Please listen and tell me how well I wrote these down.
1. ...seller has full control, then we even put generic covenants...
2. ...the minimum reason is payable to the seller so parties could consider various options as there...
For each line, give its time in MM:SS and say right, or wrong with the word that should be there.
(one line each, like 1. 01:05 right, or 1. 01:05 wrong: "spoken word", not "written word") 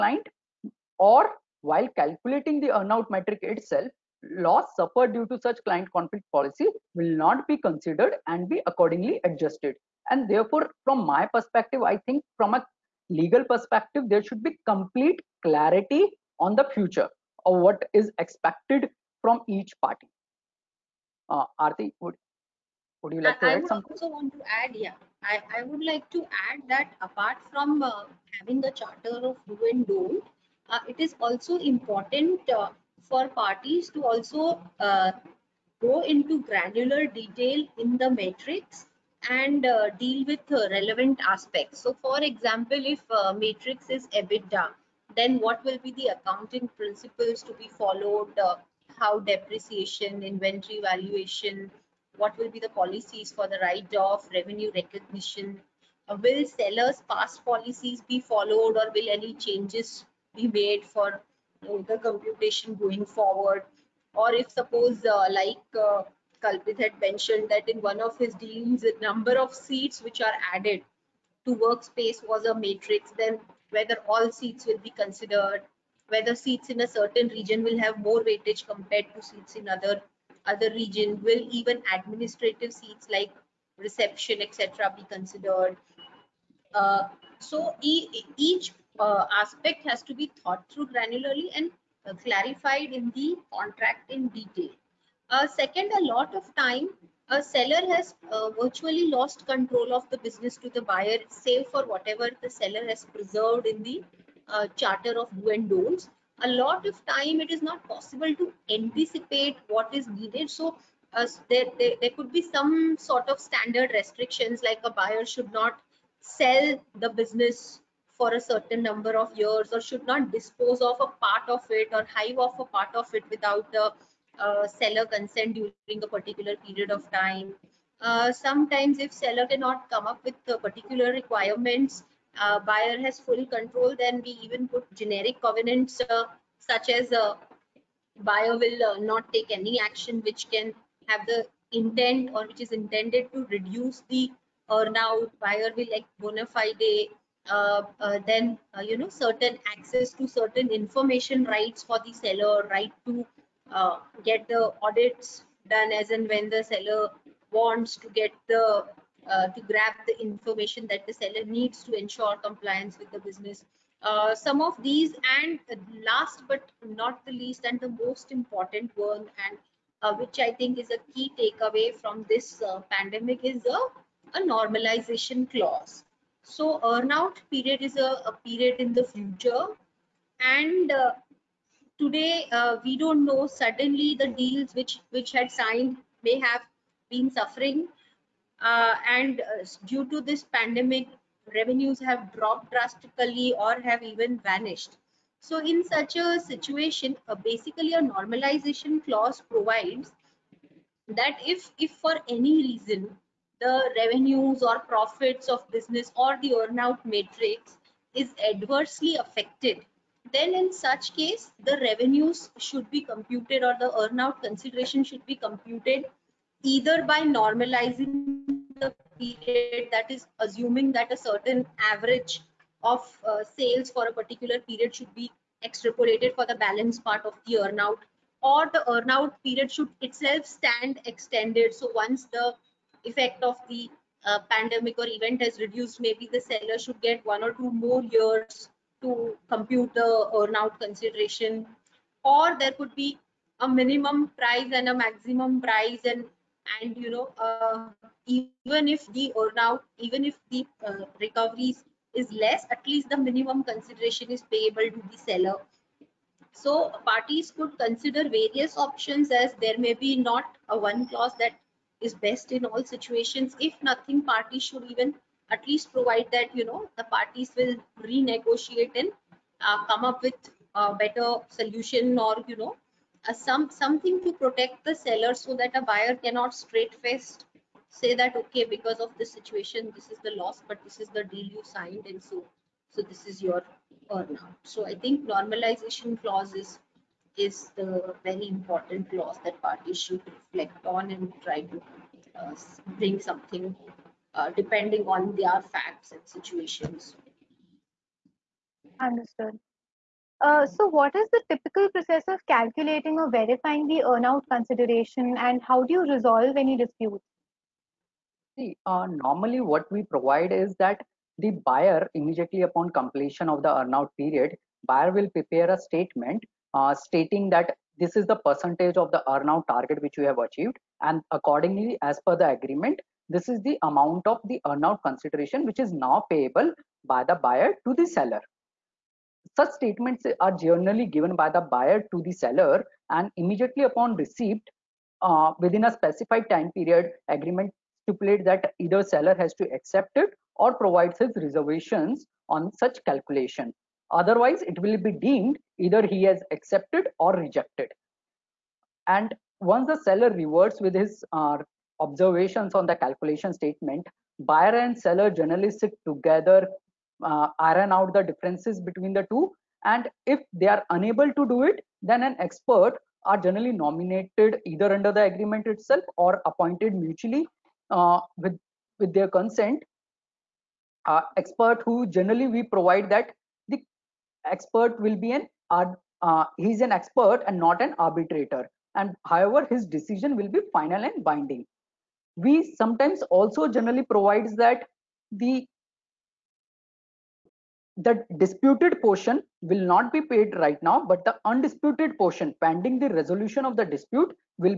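1. 02:12 wrong: "buyer", not "seller"
2. 04:13 wrong: "consideration", not "reason".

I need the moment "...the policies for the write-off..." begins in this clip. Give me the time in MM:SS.
00:52.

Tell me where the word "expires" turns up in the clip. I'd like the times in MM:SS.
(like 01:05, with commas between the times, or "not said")
not said.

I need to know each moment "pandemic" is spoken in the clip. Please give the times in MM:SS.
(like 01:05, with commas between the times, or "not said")
02:52, 03:10, 03:54.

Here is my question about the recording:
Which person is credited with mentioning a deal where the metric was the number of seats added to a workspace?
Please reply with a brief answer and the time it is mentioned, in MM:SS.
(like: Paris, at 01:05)
Kalpit, at 01:06.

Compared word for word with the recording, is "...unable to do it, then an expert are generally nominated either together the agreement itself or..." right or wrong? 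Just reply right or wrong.
wrong.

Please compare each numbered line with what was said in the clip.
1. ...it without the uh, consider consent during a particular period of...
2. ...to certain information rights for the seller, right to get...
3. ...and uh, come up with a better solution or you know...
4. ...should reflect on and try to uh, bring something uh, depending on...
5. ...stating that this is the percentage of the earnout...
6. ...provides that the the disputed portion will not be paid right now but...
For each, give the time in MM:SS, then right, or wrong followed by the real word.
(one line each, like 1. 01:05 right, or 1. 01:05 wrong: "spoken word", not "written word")
1. 02:03 wrong: "seller", not "consider"
2. 02:30 right
3. 04:29 right
4. 04:49 right
5. 05:16 right
6. 06:24 right.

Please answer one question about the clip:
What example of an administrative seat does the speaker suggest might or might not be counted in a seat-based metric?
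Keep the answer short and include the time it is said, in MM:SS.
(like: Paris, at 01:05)
reception, at 01:23.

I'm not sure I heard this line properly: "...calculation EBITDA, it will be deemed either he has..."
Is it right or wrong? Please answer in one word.
wrong.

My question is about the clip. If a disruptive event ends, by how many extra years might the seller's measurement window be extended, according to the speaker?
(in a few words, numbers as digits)
1 or 2.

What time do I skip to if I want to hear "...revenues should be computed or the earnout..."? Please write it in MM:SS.
03:31.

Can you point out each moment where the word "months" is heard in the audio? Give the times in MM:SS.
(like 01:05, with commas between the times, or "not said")
not said.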